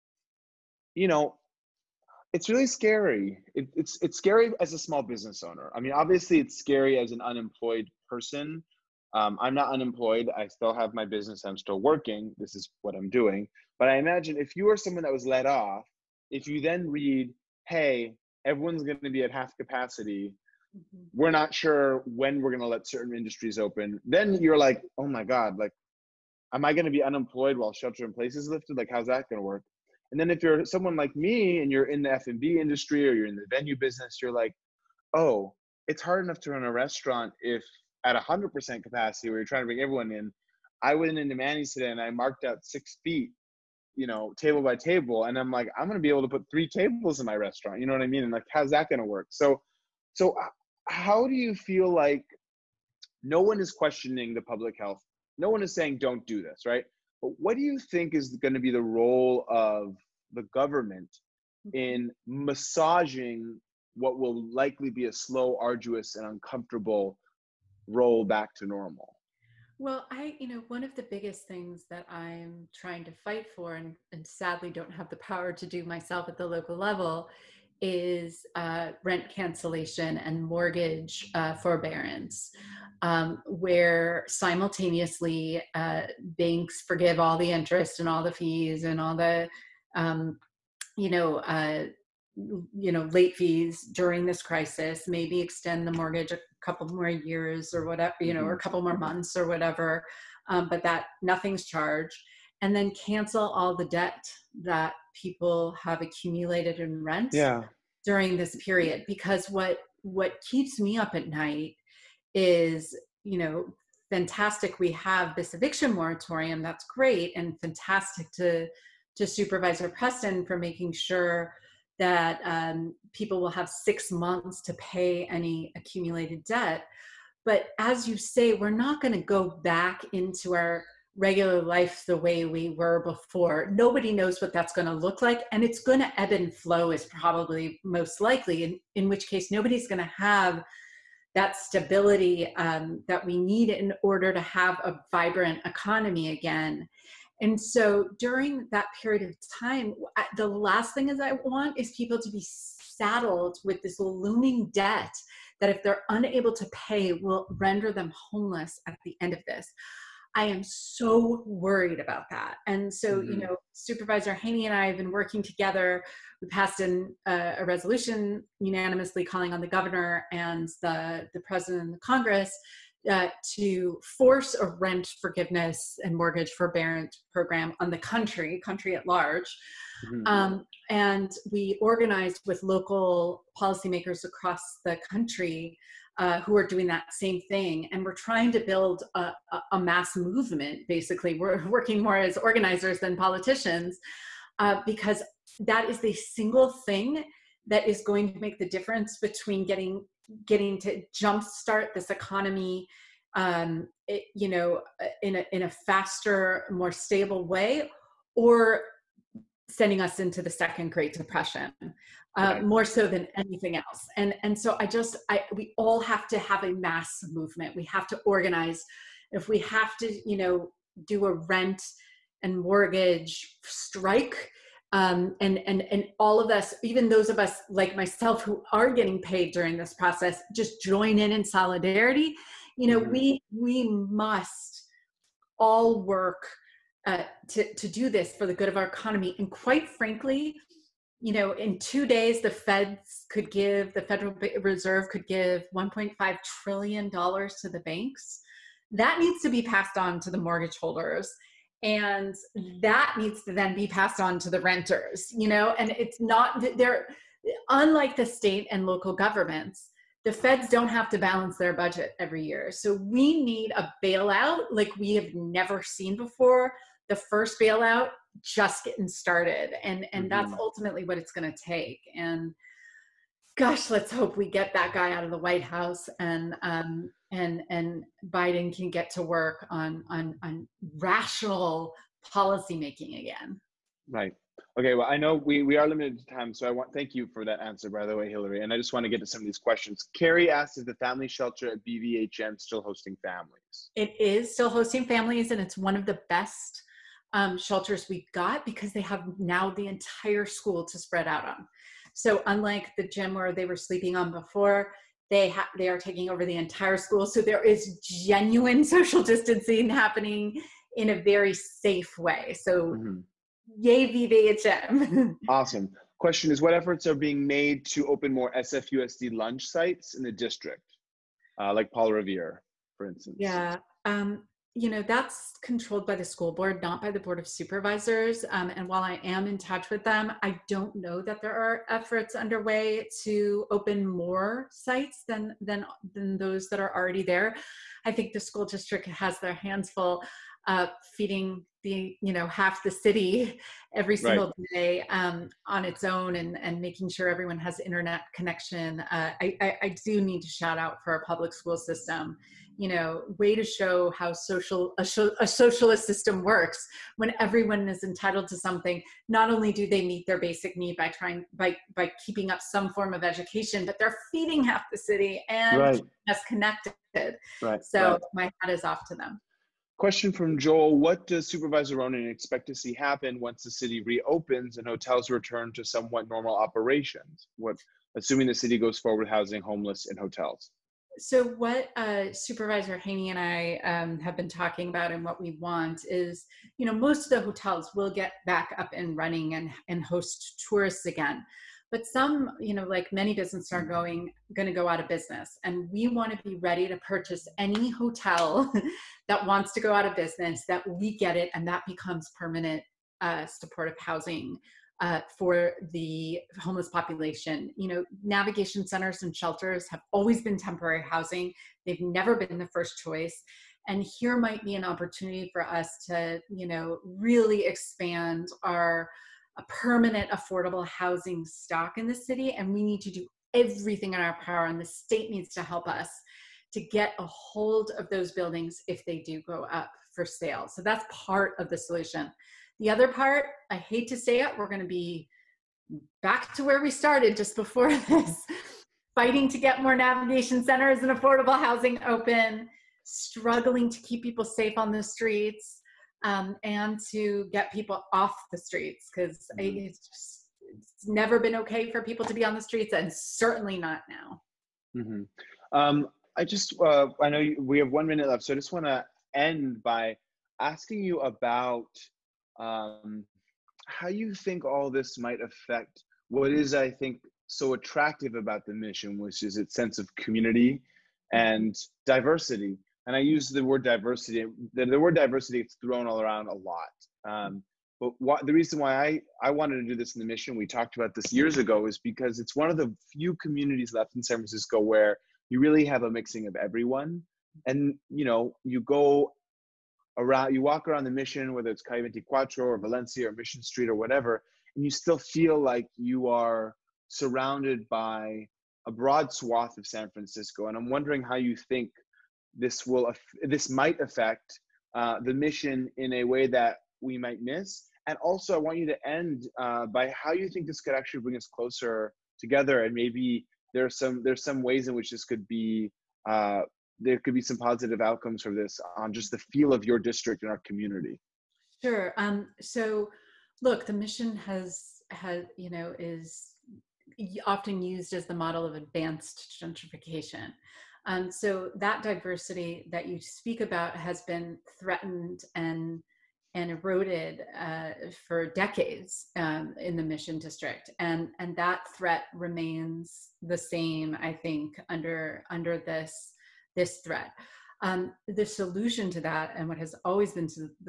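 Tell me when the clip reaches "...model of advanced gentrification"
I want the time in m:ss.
8:48.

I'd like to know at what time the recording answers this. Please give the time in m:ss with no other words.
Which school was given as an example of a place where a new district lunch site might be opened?
5:21.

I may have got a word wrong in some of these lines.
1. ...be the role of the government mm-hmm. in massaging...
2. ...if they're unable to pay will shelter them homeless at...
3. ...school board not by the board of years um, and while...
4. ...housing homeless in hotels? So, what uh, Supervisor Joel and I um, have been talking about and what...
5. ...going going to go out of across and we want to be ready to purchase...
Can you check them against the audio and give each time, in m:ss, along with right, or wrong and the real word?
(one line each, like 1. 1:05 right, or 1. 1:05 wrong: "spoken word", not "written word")
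1. 0:58 right
2. 2:35 wrong: "render", not "shelter"
3. 5:26 wrong: "supervisors", not "years"
4. 6:19 wrong: "Haney", not "Joel"
5. 6:33 wrong: "business", not "across".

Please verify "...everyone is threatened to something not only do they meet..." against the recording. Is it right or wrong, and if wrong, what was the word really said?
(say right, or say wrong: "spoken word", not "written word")
wrong: "entitled", not "threatened".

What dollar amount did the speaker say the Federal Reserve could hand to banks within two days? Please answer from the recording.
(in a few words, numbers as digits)
1.5 trillion dollars.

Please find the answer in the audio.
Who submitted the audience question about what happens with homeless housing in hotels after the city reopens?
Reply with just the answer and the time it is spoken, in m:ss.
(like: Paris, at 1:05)
Joel, at 6:10.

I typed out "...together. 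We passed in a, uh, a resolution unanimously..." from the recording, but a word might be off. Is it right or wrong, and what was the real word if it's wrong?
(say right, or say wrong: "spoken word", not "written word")
right.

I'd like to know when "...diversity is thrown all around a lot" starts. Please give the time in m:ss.
7:55.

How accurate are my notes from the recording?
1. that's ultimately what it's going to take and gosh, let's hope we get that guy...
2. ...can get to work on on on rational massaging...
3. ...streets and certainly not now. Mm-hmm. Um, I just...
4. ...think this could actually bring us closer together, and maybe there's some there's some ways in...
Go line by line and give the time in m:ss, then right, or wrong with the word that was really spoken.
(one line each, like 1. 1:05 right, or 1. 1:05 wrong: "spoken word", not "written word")
1. 4:30 right
2. 4:38 wrong: "policymaking", not "massaging"
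3. 7:32 right
4. 8:30 right.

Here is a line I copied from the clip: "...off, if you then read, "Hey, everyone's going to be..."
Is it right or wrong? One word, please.
right.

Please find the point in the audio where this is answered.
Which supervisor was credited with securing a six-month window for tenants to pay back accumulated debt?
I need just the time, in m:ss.
1:59.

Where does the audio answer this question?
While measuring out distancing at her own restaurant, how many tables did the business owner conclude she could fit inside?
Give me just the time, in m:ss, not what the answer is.
0:46.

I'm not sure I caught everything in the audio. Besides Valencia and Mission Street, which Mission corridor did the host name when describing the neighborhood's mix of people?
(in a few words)
Calle 24.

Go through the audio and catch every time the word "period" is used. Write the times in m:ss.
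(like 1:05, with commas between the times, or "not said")
1:48, 2:29.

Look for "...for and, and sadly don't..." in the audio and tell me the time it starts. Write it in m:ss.
1:13.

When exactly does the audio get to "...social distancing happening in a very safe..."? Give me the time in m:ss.
5:08.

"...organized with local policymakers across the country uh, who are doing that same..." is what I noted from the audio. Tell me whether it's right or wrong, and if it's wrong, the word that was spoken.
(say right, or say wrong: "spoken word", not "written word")
right.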